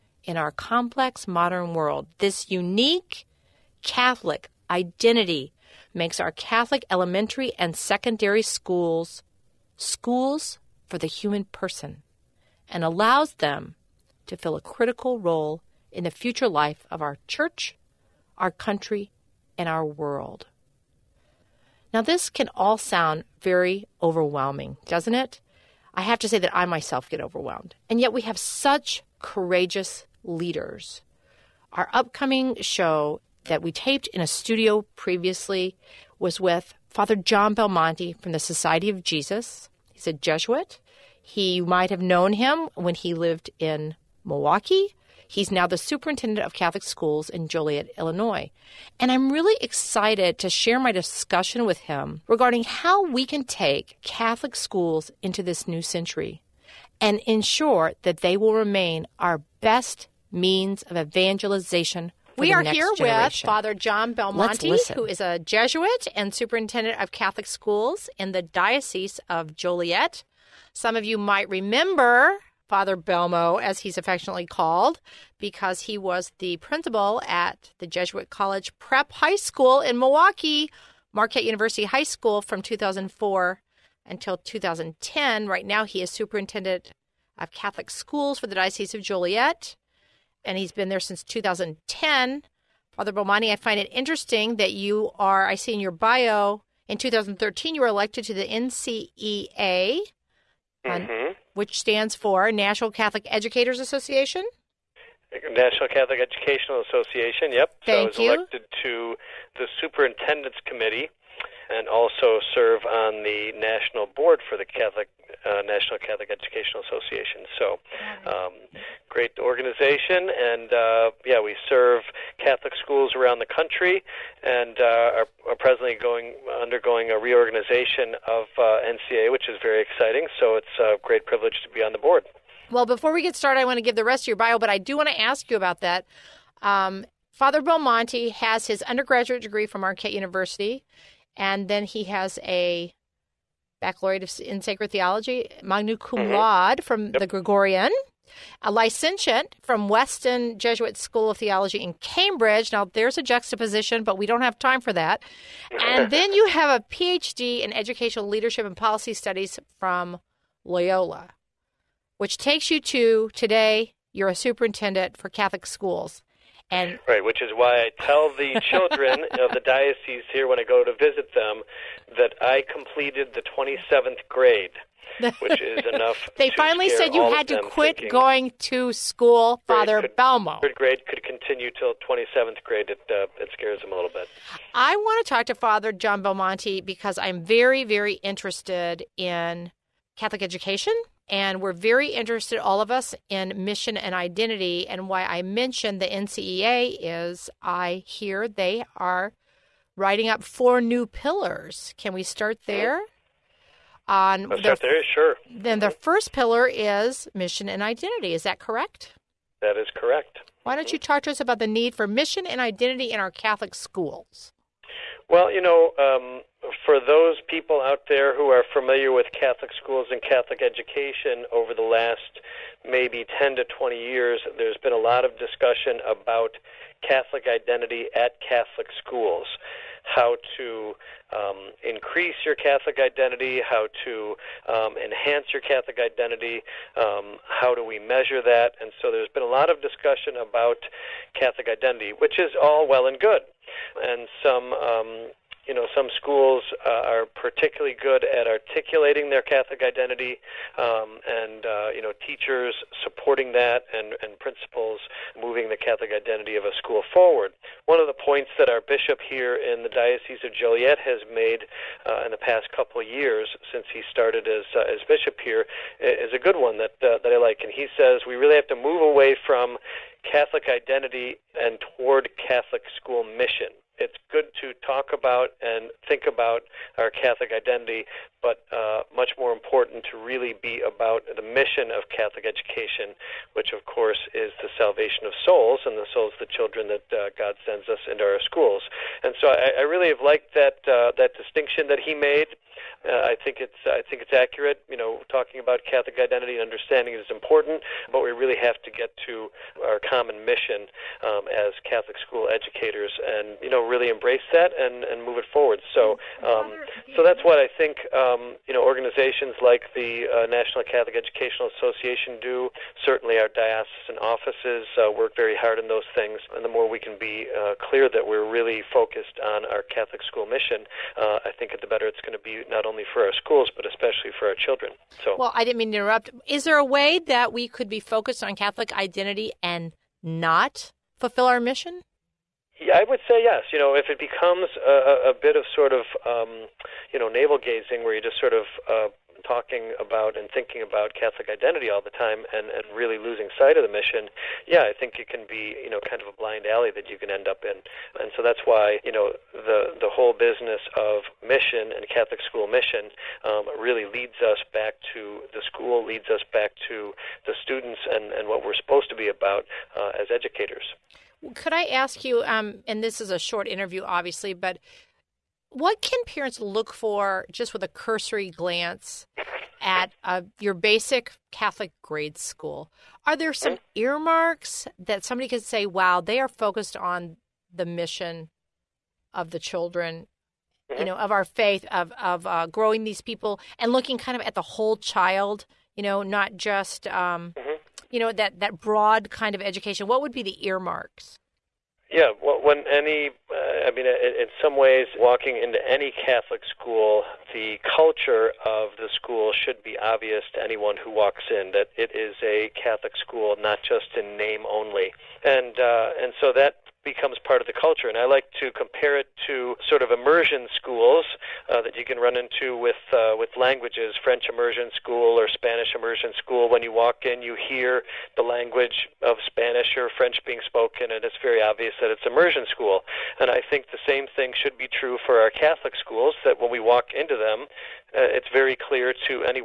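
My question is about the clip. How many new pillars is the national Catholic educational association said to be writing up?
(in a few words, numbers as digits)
4.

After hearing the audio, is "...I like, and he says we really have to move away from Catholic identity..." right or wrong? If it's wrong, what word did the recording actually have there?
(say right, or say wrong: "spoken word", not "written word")
right.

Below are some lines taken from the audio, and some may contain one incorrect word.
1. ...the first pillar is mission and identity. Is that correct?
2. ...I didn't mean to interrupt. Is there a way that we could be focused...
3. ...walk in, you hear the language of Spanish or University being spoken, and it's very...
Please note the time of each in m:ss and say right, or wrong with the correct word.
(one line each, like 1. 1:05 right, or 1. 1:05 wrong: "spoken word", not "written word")
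1. 3:25 right
2. 5:25 right
3. 6:56 wrong: "French", not "University".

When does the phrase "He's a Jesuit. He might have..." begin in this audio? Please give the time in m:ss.
0:39.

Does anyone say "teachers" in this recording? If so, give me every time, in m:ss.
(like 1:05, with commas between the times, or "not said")
4:12.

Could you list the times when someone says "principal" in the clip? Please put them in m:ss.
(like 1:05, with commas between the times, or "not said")
1:16, 4:14.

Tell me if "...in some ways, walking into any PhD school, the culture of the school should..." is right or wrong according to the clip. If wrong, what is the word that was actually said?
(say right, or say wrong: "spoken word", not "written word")
wrong: "Catholic", not "PhD".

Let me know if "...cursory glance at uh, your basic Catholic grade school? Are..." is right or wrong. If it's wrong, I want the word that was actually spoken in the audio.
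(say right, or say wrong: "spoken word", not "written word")
right.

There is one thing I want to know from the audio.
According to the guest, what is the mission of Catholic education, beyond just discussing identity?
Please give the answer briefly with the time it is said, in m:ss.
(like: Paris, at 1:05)
salvation of souls, at 4:44.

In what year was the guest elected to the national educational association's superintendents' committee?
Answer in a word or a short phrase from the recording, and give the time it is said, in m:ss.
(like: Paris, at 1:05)
2013, at 1:36.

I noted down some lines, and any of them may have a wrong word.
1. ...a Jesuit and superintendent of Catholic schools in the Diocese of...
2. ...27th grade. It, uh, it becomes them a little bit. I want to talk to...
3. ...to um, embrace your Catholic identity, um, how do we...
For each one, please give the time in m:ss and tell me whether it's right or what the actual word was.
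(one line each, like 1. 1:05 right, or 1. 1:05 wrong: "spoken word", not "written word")
1. 1:05 right
2. 3:02 wrong: "scares", not "becomes"
3. 3:54 wrong: "enhance", not "embrace".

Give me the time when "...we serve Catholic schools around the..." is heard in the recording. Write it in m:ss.
2:01.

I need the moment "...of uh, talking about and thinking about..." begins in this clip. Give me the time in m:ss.
5:38.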